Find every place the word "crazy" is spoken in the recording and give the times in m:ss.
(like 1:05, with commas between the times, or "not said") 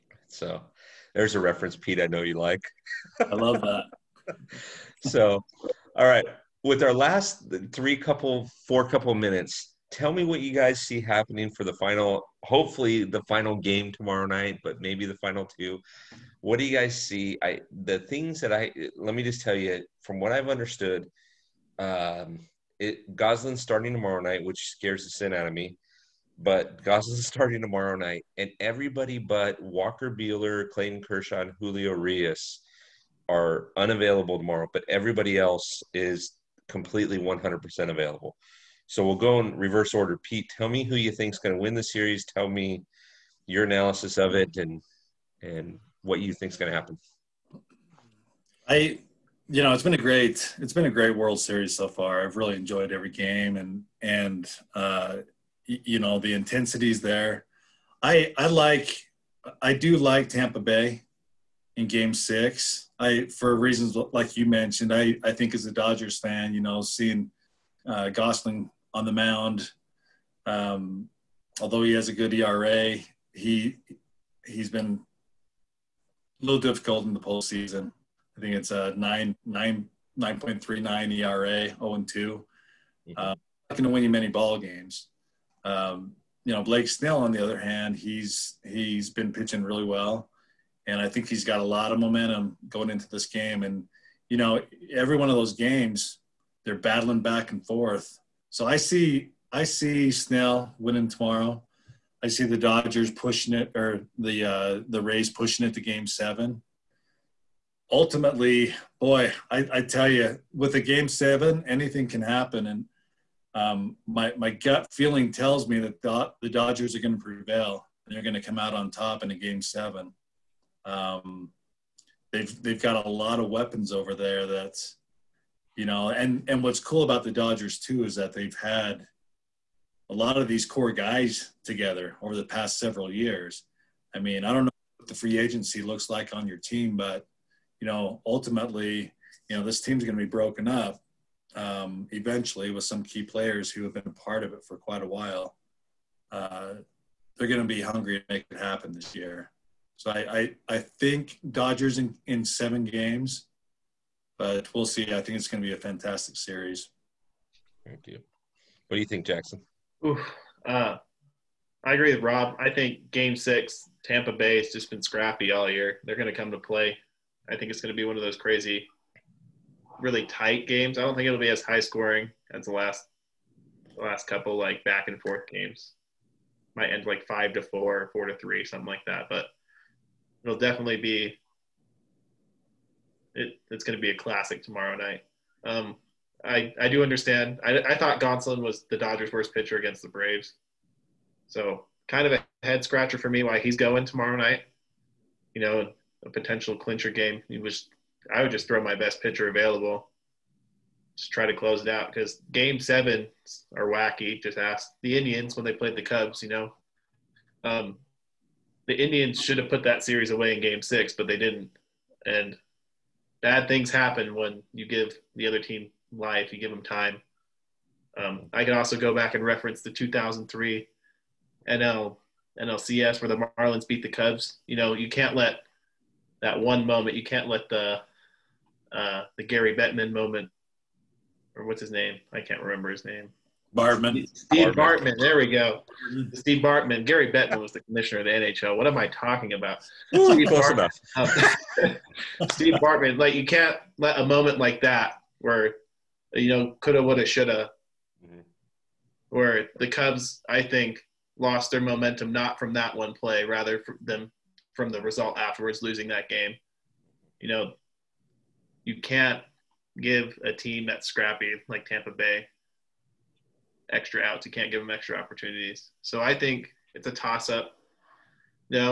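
2:48.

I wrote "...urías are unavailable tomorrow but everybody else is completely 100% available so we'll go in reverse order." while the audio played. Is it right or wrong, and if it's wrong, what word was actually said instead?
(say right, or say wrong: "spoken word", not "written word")
right.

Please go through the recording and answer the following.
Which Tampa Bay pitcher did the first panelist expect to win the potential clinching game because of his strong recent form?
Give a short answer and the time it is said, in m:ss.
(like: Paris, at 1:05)
Blake Snell, at 1:26.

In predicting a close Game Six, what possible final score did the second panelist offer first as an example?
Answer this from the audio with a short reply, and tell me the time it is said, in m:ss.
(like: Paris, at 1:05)
5-4, at 2:57.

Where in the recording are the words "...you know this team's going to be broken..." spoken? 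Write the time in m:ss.
2:19.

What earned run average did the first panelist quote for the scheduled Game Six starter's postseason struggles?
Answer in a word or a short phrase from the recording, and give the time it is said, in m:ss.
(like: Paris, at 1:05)
9.39, at 1:20.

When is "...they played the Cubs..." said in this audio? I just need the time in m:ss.
3:25.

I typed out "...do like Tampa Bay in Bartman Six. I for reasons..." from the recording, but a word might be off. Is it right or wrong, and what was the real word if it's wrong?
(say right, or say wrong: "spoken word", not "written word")
wrong: "Game", not "Bartman".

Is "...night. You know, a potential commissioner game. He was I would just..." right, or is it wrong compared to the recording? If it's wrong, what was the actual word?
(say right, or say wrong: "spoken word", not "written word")
wrong: "clincher", not "commissioner".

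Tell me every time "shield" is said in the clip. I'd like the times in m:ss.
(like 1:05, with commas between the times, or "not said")
not said.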